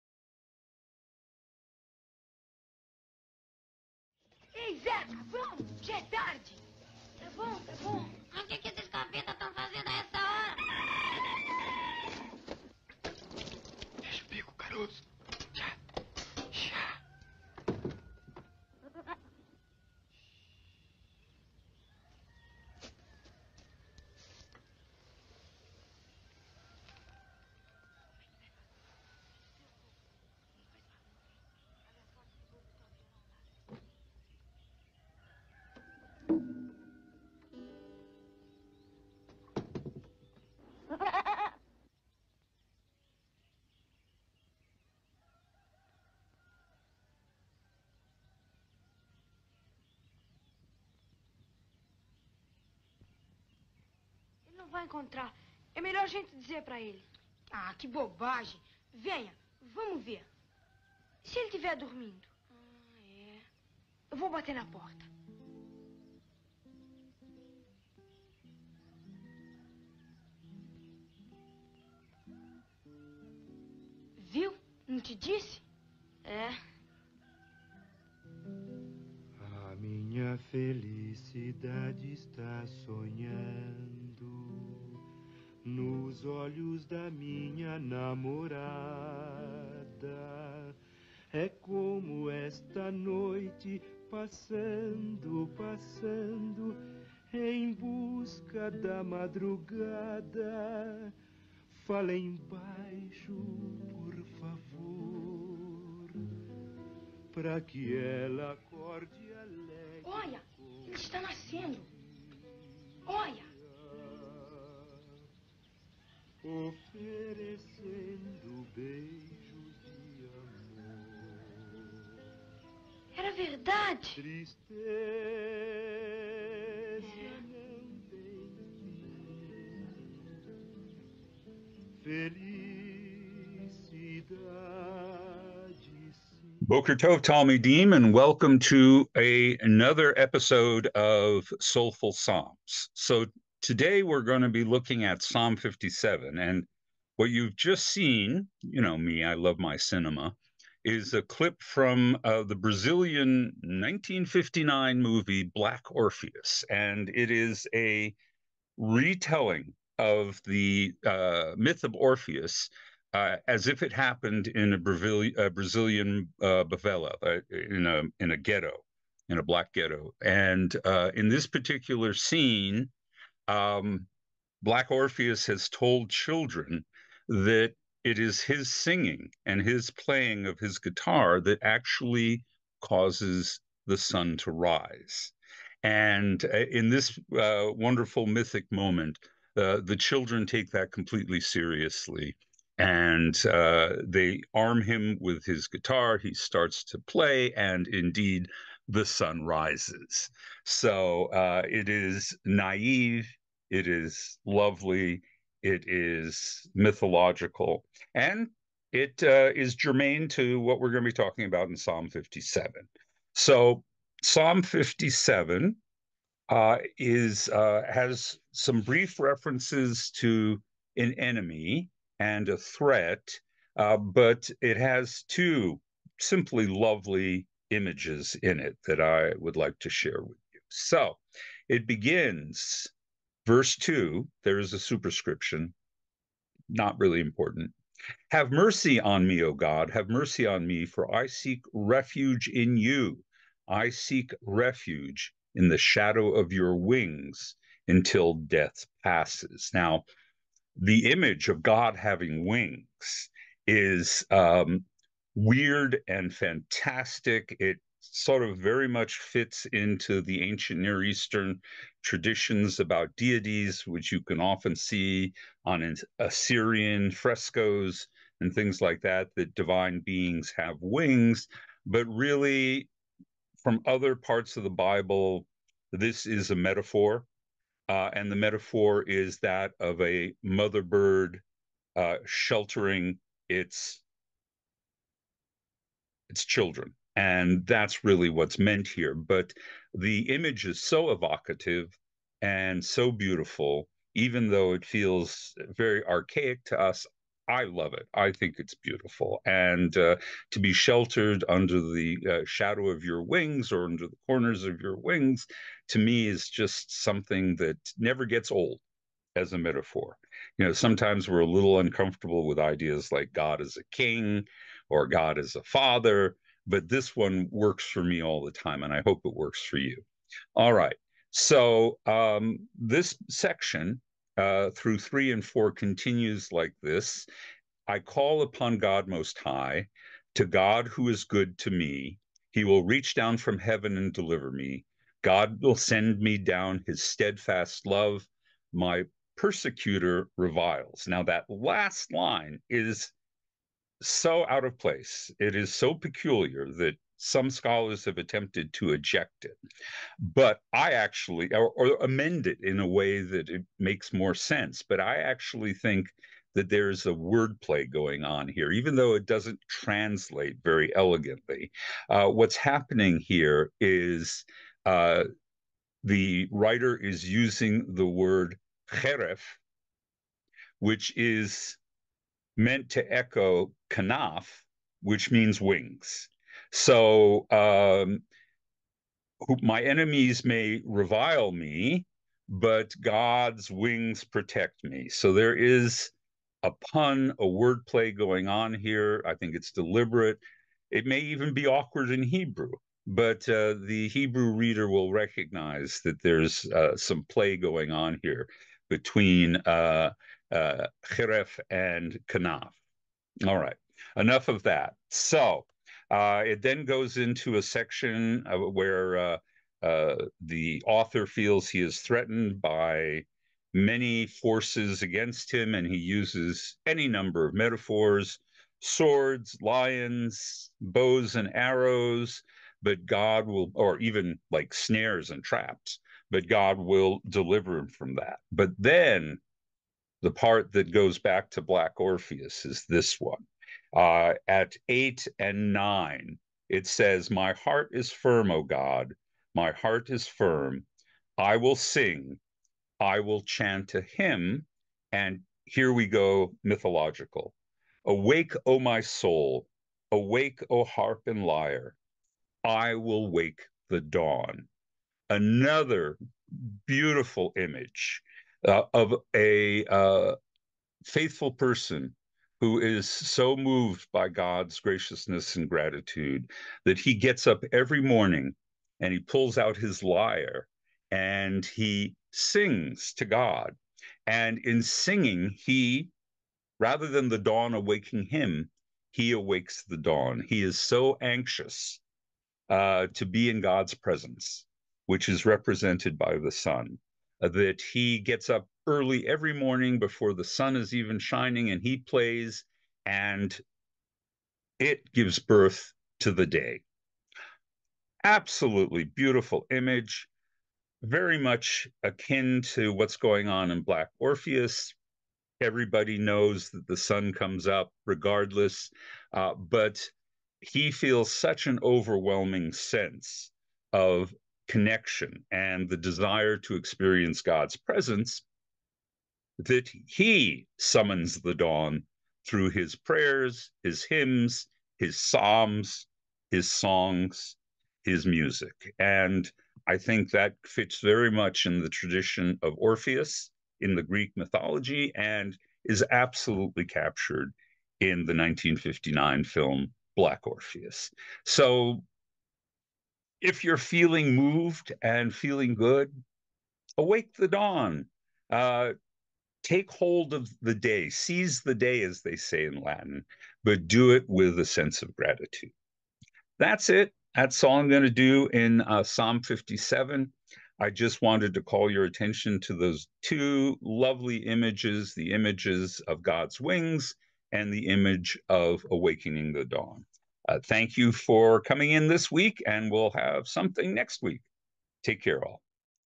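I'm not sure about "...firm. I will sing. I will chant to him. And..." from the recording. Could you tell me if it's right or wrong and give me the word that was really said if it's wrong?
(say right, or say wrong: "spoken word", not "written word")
right.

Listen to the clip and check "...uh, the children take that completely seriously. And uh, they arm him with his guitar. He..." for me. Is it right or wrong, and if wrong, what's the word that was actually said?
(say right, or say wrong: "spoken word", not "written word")
right.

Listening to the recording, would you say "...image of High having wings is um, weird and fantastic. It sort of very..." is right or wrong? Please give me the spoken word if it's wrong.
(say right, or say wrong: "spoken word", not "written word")
wrong: "God", not "High".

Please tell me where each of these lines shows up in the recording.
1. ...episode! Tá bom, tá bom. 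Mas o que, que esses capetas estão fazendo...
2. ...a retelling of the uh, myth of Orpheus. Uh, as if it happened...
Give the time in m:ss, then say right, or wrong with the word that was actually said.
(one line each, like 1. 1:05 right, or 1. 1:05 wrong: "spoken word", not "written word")
1. 0:06 wrong: "tarde", not "episode"
2. 2:37 right.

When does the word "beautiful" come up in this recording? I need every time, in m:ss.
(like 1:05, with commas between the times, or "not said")
4:53, 4:58, 7:36, 8:19.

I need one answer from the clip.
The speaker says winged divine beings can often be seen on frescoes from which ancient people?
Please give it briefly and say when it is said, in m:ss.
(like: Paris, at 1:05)
Assyrian, at 4:26.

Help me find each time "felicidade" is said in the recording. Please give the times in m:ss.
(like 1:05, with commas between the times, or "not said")
1:20, 2:12.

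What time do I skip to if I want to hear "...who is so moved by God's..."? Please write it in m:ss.
7:42.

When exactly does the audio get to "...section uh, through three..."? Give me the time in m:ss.
5:23.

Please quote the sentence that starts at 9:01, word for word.
So if you're feeling moved and feeling good, awake the dawn.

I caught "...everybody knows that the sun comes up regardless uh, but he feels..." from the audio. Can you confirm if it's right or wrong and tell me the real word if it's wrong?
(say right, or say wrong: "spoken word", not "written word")
right.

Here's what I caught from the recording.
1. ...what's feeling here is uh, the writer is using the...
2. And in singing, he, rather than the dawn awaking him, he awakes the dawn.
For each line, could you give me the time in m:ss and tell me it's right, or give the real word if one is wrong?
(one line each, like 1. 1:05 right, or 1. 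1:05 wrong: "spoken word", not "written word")
1. 6:02 wrong: "happening", not "feeling"
2. 7:54 right.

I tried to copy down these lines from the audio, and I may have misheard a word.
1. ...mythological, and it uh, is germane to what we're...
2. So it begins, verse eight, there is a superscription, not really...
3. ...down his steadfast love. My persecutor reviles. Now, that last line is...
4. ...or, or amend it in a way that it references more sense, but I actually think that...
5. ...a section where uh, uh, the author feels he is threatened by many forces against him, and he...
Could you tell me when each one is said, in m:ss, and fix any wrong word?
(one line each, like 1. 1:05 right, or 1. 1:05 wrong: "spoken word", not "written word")
1. 3:26 right
2. 3:50 wrong: "two", not "eight"
3. 5:36 right
4. 5:51 wrong: "makes", not "references"
5. 6:47 right.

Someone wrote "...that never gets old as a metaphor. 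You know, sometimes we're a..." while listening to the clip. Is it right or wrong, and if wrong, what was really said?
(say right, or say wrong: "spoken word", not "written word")
right.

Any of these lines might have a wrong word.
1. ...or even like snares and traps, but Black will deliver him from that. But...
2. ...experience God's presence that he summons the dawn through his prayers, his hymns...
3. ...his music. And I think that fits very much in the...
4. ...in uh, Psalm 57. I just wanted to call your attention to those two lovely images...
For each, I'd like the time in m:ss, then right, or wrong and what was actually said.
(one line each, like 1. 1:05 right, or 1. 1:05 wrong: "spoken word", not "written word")
1. 7:03 wrong: "God", not "Black"
2. 8:36 right
3. 8:48 right
4. 9:18 right.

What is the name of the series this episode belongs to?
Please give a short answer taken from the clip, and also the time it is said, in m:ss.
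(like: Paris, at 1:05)
Soulful Psalms, at 2:21.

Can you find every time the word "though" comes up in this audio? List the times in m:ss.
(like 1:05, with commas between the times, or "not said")
4:54, 5:58.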